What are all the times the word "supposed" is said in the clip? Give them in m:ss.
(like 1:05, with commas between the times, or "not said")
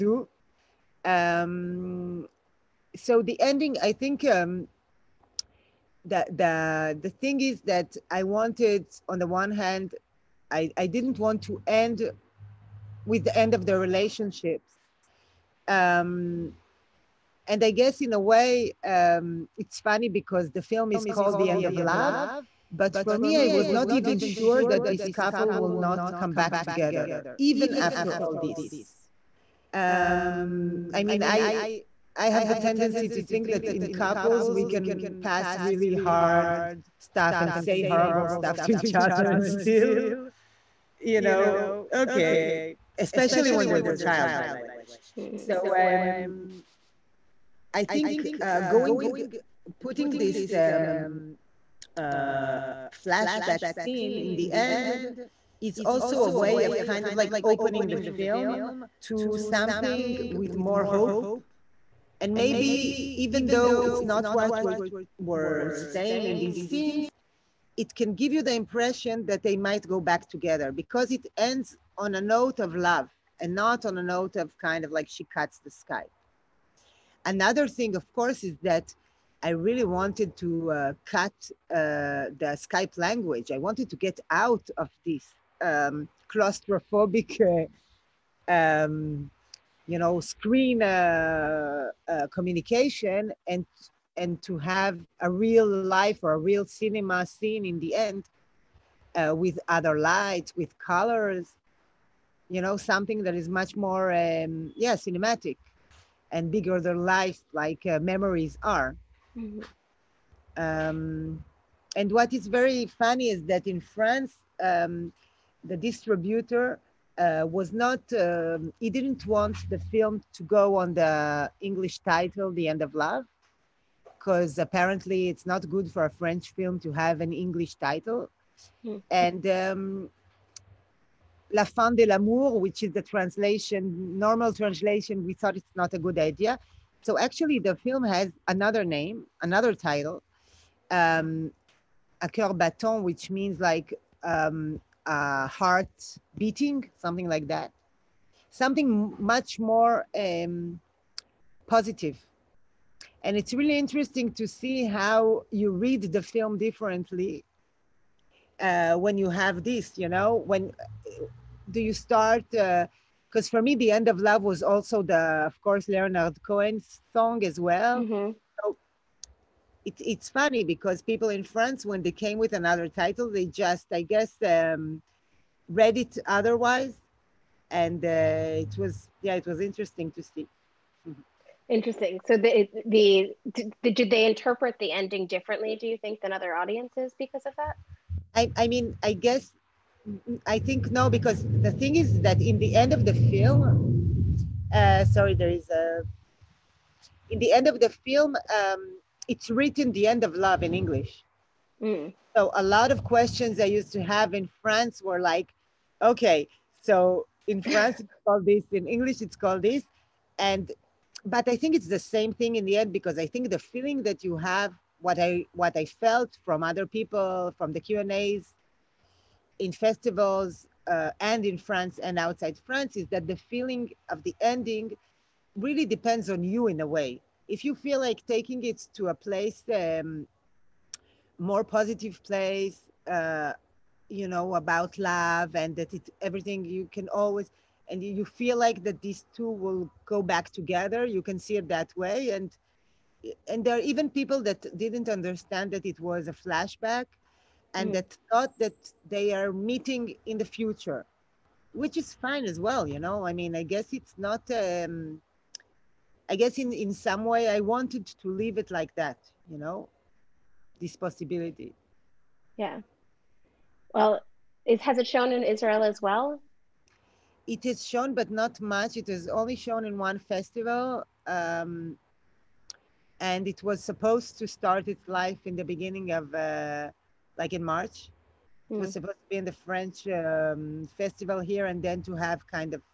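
4:33, 4:38.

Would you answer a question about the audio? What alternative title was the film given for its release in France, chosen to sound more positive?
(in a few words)
A Coeur Battant.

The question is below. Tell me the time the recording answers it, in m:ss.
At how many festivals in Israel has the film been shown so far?
4:29.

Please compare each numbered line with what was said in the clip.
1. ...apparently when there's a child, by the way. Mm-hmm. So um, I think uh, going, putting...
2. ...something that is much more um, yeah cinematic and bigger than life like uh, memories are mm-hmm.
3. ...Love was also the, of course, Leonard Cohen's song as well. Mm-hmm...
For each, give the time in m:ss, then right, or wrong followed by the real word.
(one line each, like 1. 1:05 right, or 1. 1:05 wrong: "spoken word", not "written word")
1. 0:42 wrong: "especially", not "apparently"
2. 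1:42 right
3. 2:44 right.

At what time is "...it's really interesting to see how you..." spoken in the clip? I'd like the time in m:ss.
2:33.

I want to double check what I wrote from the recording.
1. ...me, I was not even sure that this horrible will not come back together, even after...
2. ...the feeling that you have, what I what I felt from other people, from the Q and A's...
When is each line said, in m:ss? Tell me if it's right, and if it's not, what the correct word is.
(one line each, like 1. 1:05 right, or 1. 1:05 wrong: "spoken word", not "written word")
1. 0:23 wrong: "couple", not "horrible"
2. 3:33 right.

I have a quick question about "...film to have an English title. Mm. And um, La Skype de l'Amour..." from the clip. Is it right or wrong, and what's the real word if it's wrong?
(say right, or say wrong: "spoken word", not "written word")
wrong: "Fin", not "Skype".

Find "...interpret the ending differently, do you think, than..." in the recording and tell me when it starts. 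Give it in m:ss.
3:04.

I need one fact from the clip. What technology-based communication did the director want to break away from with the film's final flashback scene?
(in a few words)
Skype.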